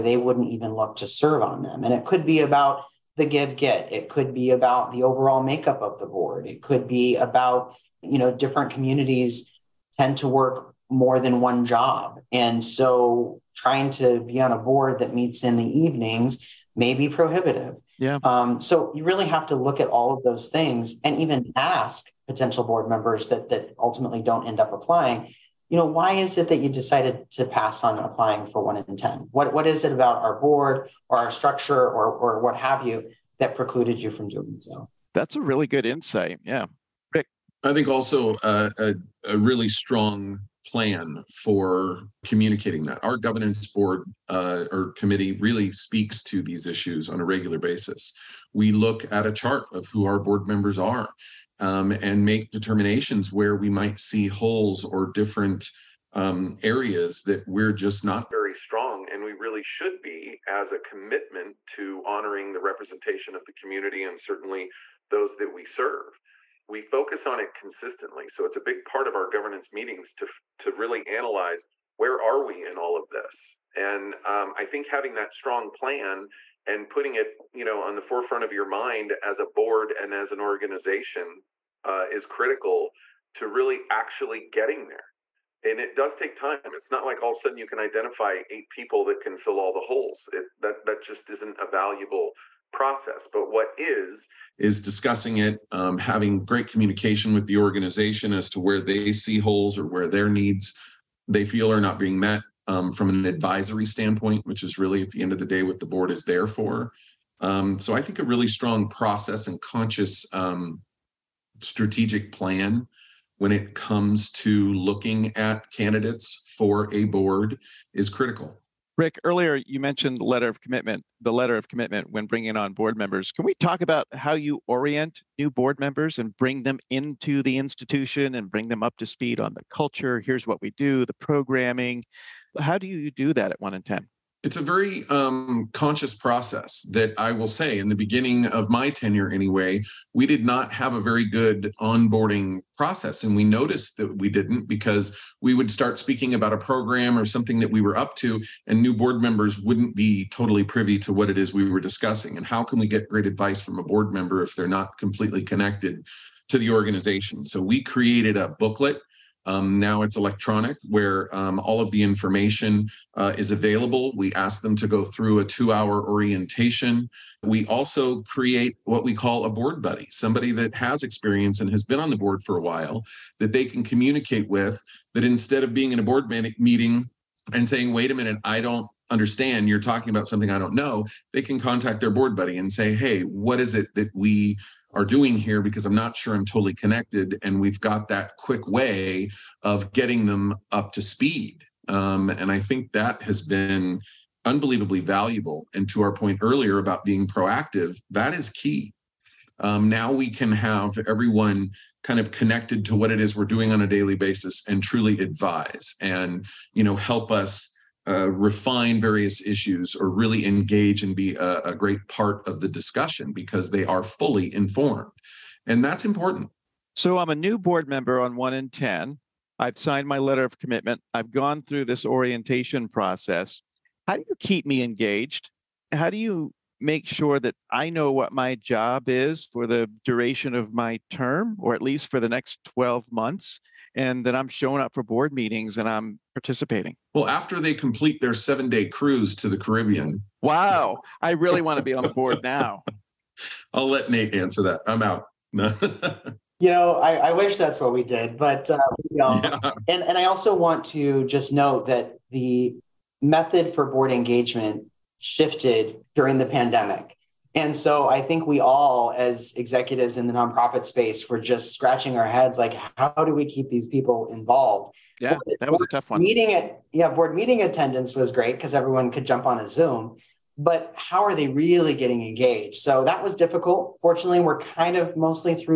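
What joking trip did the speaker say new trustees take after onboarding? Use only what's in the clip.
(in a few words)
7-day Caribbean cruise.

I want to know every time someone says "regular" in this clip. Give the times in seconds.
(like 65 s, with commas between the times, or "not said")
47 s.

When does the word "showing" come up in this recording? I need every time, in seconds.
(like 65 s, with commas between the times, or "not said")
234 s.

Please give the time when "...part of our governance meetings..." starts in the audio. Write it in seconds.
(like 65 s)
68 s.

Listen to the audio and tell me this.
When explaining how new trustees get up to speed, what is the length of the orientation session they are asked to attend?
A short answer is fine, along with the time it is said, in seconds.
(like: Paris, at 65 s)
2 hours, at 165 s.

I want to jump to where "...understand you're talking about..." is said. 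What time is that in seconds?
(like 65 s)
179 s.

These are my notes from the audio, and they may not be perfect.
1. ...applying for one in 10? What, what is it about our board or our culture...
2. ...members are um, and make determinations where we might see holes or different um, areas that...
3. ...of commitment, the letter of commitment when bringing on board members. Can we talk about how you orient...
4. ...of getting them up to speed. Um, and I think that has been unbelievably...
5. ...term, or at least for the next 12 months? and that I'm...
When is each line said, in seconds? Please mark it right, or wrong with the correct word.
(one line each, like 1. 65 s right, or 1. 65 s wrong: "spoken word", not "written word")
1. 27 s wrong: "structure", not "culture"
2. 50 s right
3. 120 s right
4. 189 s right
5. 231 s right.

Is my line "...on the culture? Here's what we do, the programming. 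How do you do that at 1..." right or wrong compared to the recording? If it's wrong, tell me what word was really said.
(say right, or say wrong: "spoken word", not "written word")
right.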